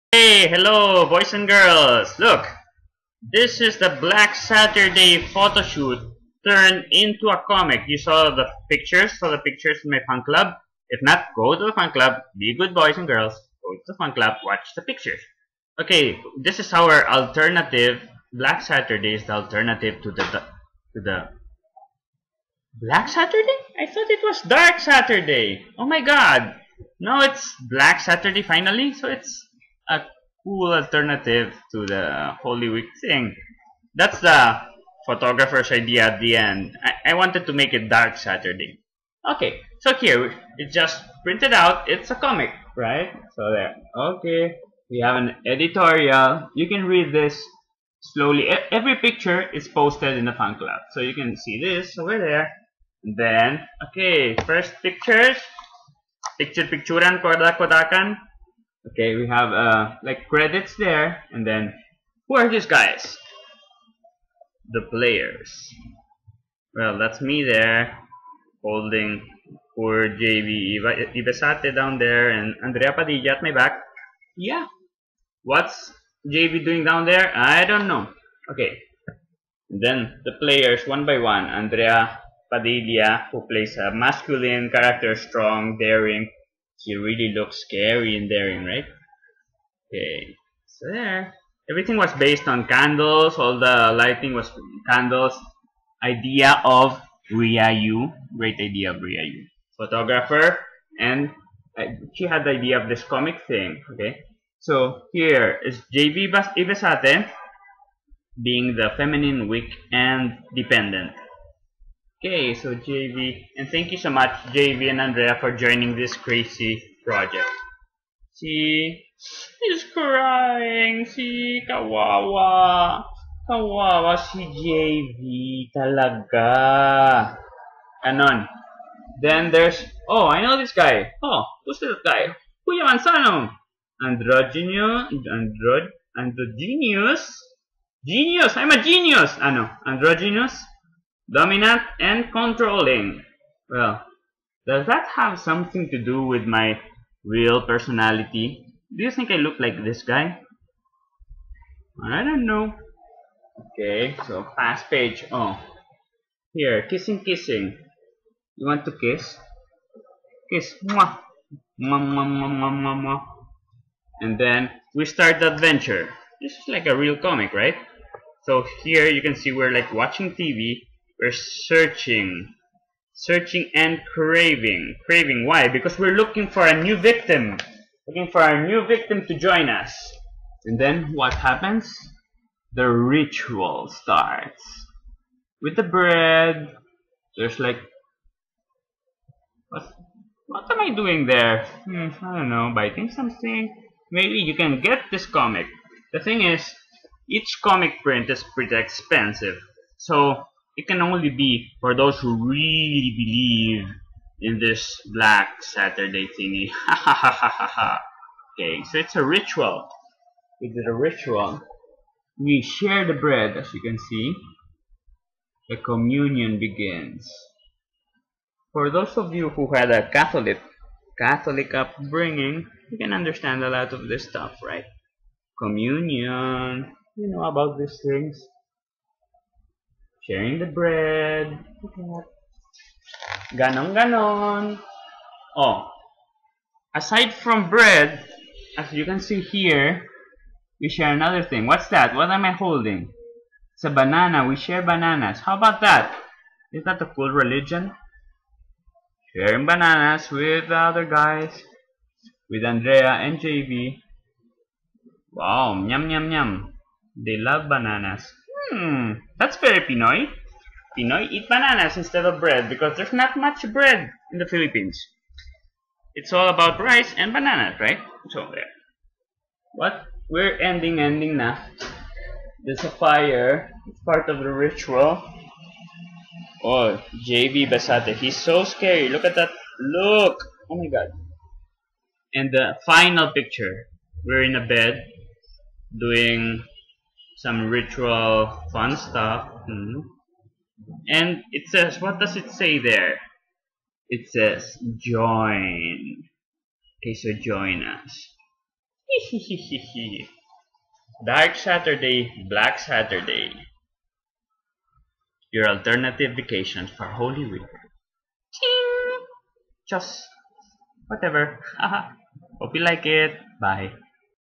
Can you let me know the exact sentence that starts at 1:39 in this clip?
Photographer, and uh, she had the idea of this comic thing, okay?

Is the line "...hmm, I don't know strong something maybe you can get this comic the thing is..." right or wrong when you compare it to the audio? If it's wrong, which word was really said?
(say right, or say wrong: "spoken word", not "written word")
wrong: "biting", not "strong".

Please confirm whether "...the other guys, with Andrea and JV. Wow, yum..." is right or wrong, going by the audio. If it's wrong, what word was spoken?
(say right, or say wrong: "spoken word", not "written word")
right.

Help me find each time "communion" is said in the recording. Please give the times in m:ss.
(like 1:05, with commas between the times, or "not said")
3:35, 3:45.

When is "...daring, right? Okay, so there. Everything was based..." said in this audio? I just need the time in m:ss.
1:28.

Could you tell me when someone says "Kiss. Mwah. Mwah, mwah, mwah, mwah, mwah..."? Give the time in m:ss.
2:40.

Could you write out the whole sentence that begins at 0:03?
This is the Black Saturday photo shoot turned into a comic.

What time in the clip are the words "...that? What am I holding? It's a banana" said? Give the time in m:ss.
4:01.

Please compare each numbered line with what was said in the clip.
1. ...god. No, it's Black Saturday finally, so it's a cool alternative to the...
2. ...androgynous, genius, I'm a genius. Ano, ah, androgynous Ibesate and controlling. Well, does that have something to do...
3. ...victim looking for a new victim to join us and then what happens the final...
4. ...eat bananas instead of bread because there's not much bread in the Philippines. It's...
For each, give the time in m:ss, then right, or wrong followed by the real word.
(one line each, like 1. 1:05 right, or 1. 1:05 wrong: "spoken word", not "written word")
1. 0:26 right
2. 2:16 wrong: "Dominant", not "Ibesate"
3. 2:56 wrong: "ritual", not "final"
4. 4:21 right.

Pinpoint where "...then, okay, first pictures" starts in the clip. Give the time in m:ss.
0:53.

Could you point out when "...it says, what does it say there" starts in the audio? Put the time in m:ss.
4:51.